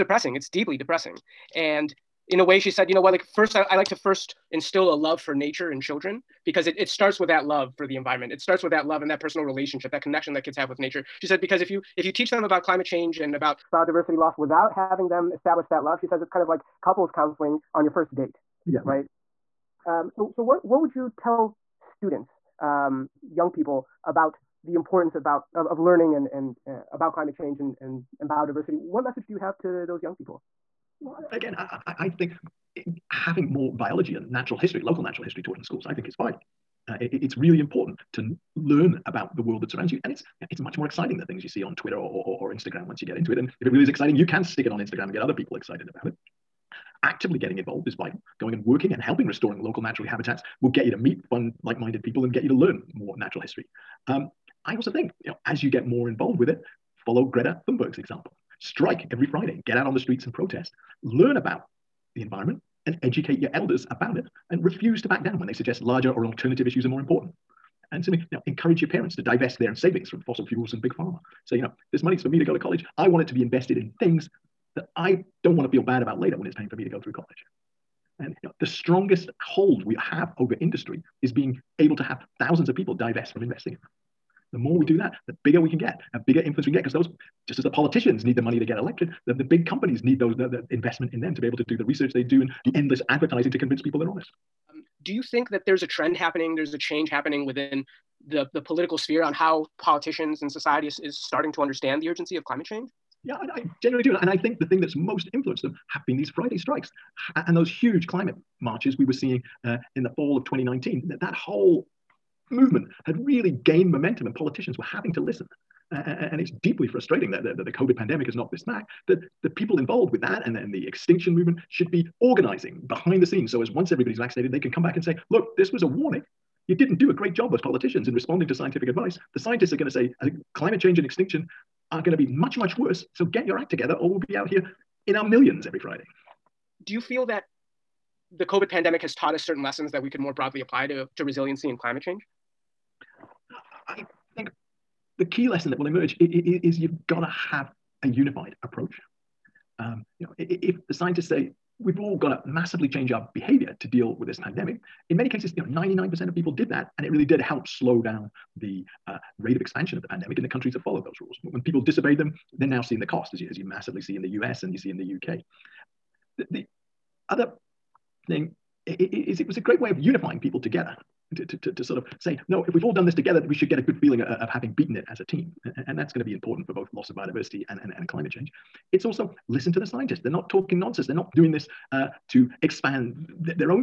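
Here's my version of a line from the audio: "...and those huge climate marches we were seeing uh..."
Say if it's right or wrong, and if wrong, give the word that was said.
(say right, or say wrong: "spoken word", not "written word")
right.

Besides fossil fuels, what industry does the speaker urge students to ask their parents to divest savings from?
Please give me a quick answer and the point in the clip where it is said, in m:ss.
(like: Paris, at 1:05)
big pharma, at 1:10.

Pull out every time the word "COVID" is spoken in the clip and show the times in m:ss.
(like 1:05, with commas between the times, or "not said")
1:57, 2:18.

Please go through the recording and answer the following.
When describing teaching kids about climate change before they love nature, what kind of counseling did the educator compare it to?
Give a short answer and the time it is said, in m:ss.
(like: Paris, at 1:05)
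couples counseling, at 0:16.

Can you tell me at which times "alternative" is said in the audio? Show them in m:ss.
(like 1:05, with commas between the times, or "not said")
1:06.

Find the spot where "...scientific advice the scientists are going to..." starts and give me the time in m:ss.
2:08.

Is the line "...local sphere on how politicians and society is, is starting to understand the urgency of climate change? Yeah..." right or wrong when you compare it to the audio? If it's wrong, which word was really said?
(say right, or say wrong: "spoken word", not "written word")
wrong: "political", not "local".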